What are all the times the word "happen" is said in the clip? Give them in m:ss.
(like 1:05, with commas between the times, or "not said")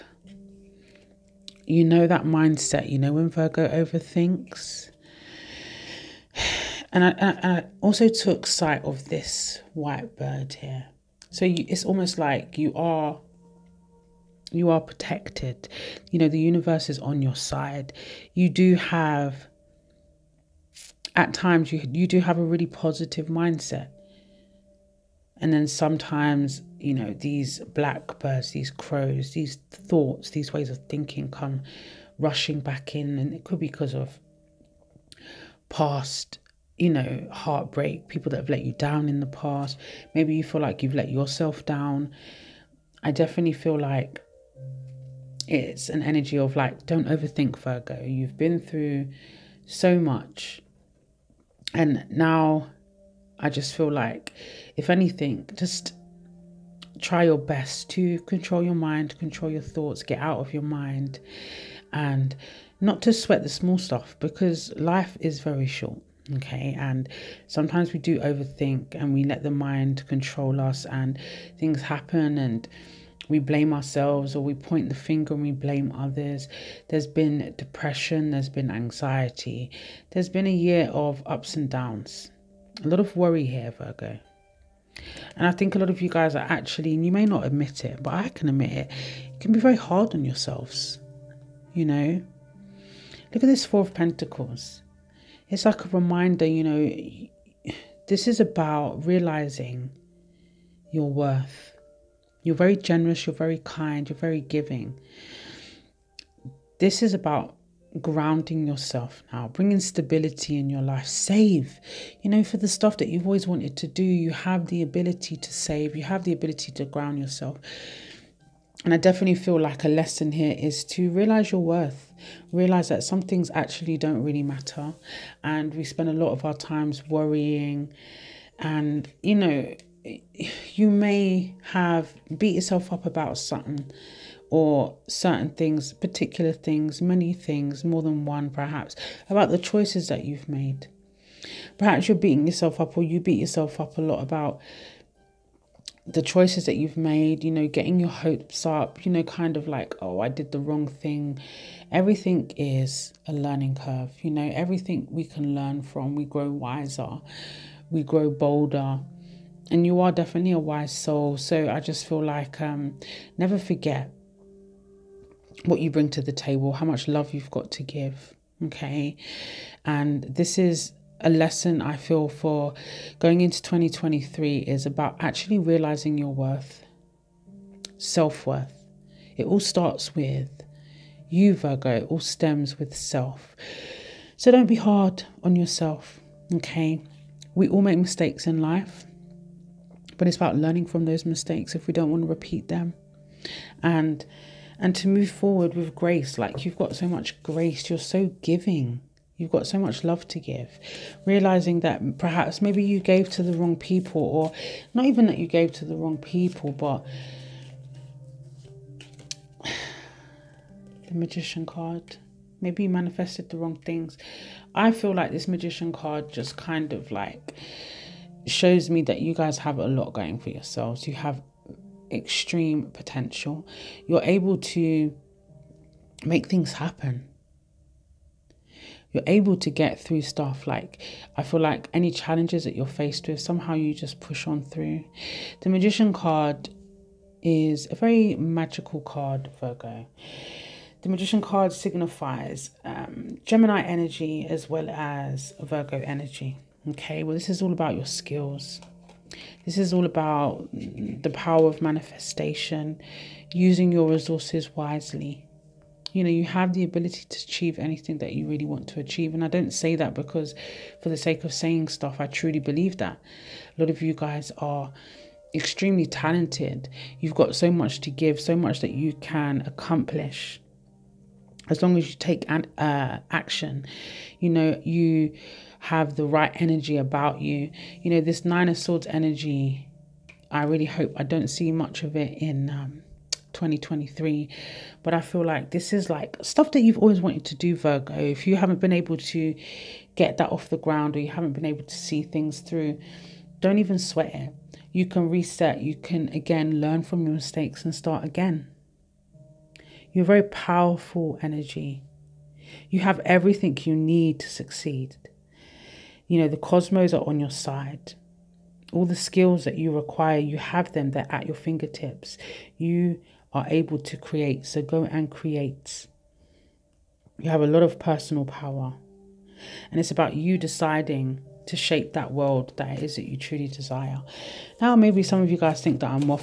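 1:11, 3:46.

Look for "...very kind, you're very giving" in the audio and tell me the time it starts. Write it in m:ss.
1:43.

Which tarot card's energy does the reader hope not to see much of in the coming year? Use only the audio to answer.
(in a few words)
Nine of Swords.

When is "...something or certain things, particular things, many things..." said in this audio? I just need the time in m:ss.
2:13.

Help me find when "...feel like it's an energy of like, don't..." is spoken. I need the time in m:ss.
0:43.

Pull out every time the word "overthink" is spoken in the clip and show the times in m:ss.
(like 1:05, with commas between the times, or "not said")
0:03, 0:47, 1:08.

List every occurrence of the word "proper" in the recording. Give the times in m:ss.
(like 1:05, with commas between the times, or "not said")
not said.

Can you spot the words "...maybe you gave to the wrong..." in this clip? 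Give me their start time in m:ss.
3:22.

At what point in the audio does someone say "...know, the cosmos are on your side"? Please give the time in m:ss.
5:06.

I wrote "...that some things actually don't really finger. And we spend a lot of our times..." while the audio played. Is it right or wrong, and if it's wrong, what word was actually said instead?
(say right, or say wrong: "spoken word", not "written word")
wrong: "matter", not "finger".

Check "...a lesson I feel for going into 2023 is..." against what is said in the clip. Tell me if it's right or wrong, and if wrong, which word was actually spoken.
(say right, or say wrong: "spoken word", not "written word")
right.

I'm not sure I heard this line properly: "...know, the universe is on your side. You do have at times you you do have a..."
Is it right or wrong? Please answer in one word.
right.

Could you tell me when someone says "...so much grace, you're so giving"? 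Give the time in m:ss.
3:16.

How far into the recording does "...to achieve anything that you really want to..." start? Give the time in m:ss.
4:17.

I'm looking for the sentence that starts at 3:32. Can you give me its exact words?
Maybe you manifested the wrong things.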